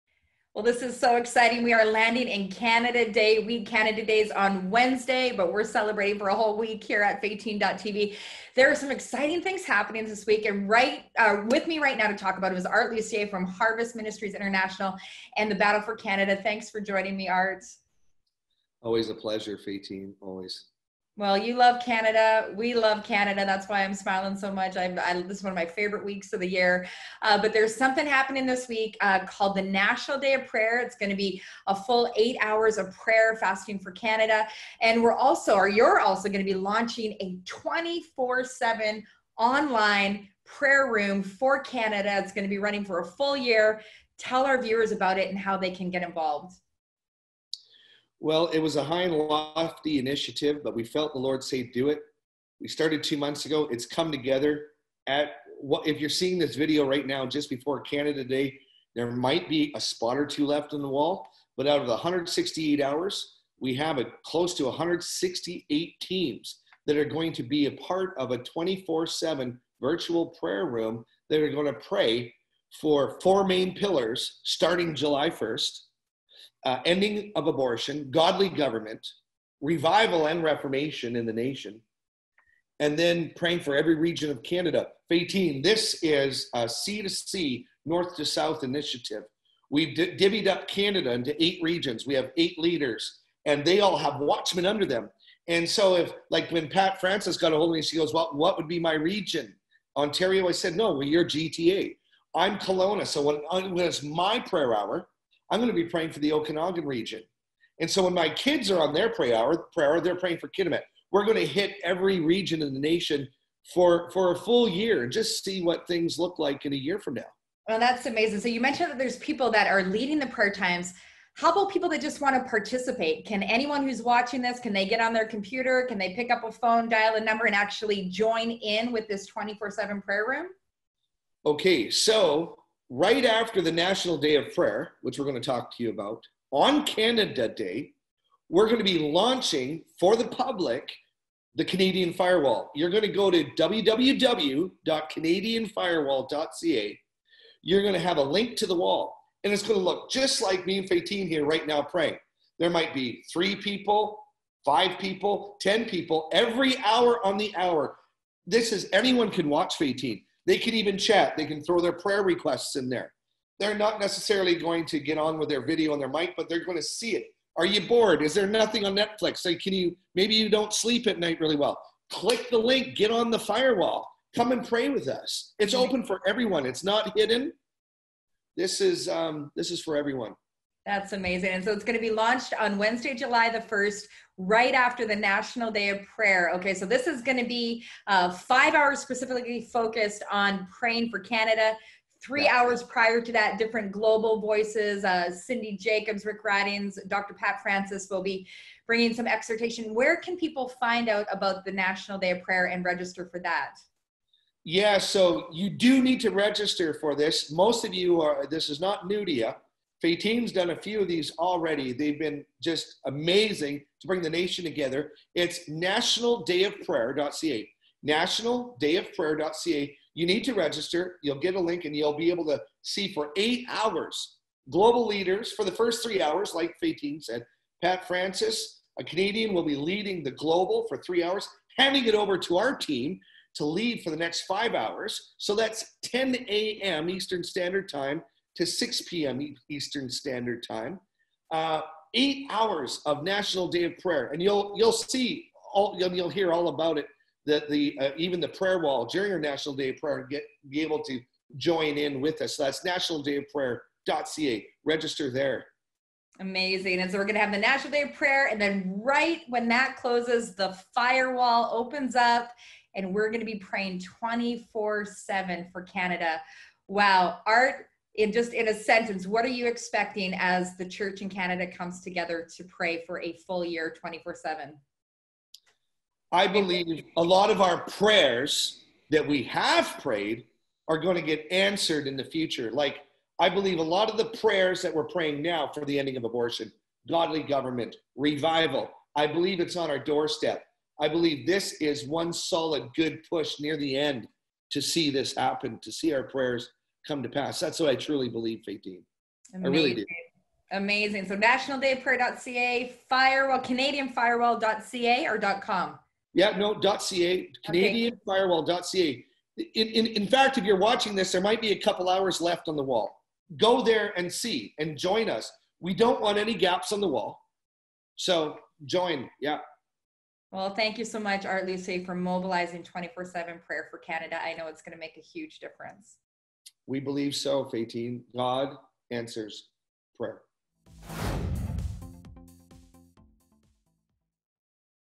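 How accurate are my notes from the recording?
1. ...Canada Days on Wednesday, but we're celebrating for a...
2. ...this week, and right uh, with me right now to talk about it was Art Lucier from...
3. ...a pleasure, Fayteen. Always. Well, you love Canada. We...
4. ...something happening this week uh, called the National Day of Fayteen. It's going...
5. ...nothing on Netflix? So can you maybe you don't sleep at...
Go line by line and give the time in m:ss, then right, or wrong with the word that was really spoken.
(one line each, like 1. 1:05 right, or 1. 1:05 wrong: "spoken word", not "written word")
1. 0:03 right
2. 0:10 right
3. 0:19 right
4. 0:27 wrong: "Prayer", not "Fayteen"
5. 2:48 right.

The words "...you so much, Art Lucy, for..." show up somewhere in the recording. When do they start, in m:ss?
5:20.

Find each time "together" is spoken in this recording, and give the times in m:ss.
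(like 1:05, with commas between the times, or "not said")
0:54, 3:34, 4:32.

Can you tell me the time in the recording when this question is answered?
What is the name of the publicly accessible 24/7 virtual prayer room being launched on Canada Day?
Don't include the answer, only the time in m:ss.
2:21.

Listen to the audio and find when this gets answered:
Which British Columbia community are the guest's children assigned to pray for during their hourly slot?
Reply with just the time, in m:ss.
1:50.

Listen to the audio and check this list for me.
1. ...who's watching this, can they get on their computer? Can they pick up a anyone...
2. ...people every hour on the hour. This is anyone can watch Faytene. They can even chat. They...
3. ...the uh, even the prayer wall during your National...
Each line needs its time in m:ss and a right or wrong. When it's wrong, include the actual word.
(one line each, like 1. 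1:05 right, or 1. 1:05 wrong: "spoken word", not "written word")
1. 2:03 wrong: "phone", not "anyone"
2. 2:35 right
3. 4:07 right.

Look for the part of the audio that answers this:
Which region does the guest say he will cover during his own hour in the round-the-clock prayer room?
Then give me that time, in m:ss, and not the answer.
1:46.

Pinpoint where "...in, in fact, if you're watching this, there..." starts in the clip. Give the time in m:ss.
5:09.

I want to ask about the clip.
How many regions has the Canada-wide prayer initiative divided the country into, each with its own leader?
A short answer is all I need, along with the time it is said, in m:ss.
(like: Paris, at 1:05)
8, at 1:31.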